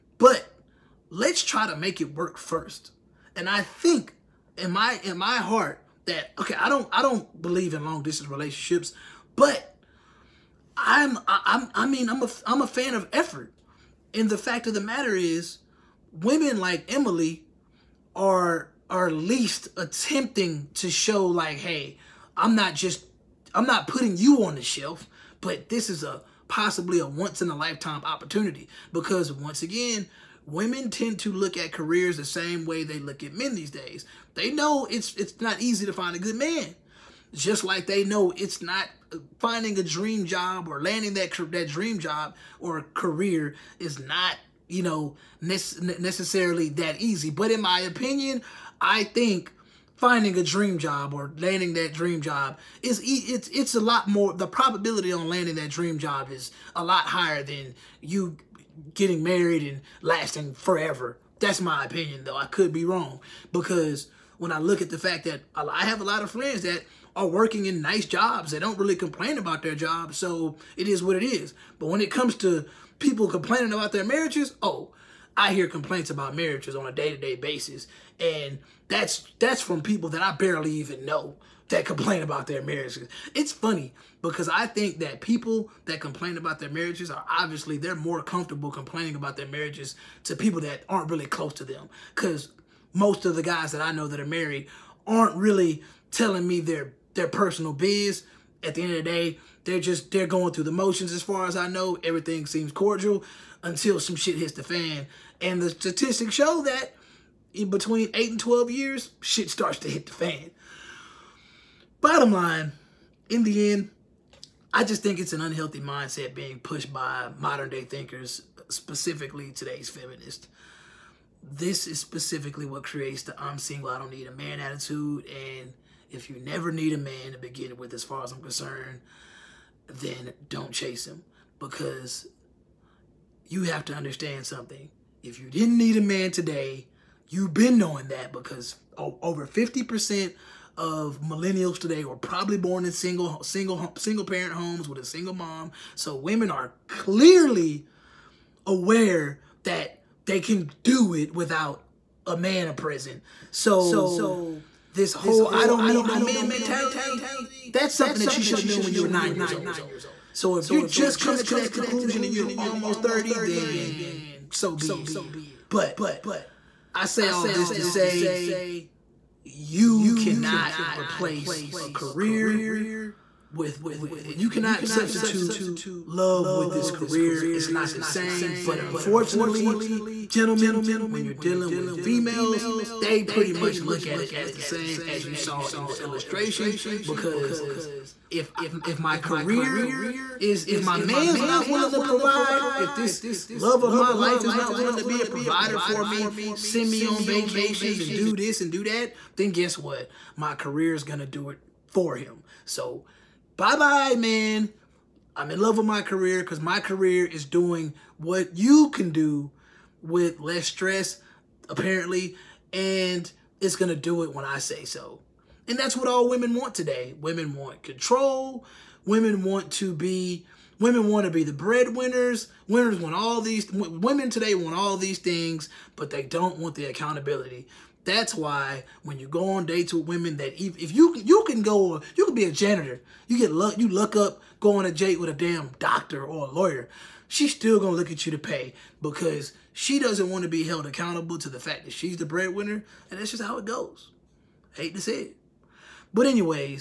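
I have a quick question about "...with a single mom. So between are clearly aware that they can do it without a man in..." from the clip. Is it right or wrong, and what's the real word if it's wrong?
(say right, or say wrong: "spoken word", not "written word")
wrong: "women", not "between".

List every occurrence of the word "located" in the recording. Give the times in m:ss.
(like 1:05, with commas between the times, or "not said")
not said.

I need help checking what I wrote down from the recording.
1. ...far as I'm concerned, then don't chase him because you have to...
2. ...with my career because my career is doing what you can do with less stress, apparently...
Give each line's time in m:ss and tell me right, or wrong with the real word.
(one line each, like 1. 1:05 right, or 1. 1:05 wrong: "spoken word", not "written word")
1. 2:08 right
2. 3:25 right.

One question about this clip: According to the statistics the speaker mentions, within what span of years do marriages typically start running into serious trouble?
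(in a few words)
8 and 12 years.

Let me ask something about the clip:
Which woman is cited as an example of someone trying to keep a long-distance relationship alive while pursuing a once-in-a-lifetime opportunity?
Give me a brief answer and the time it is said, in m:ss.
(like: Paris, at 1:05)
Emily, at 0:16.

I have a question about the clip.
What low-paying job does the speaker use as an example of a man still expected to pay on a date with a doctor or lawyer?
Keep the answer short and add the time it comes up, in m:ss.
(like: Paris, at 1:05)
janitor, at 3:52.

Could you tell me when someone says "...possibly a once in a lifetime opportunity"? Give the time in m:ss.
0:26.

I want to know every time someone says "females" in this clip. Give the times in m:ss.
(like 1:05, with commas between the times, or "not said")
3:02.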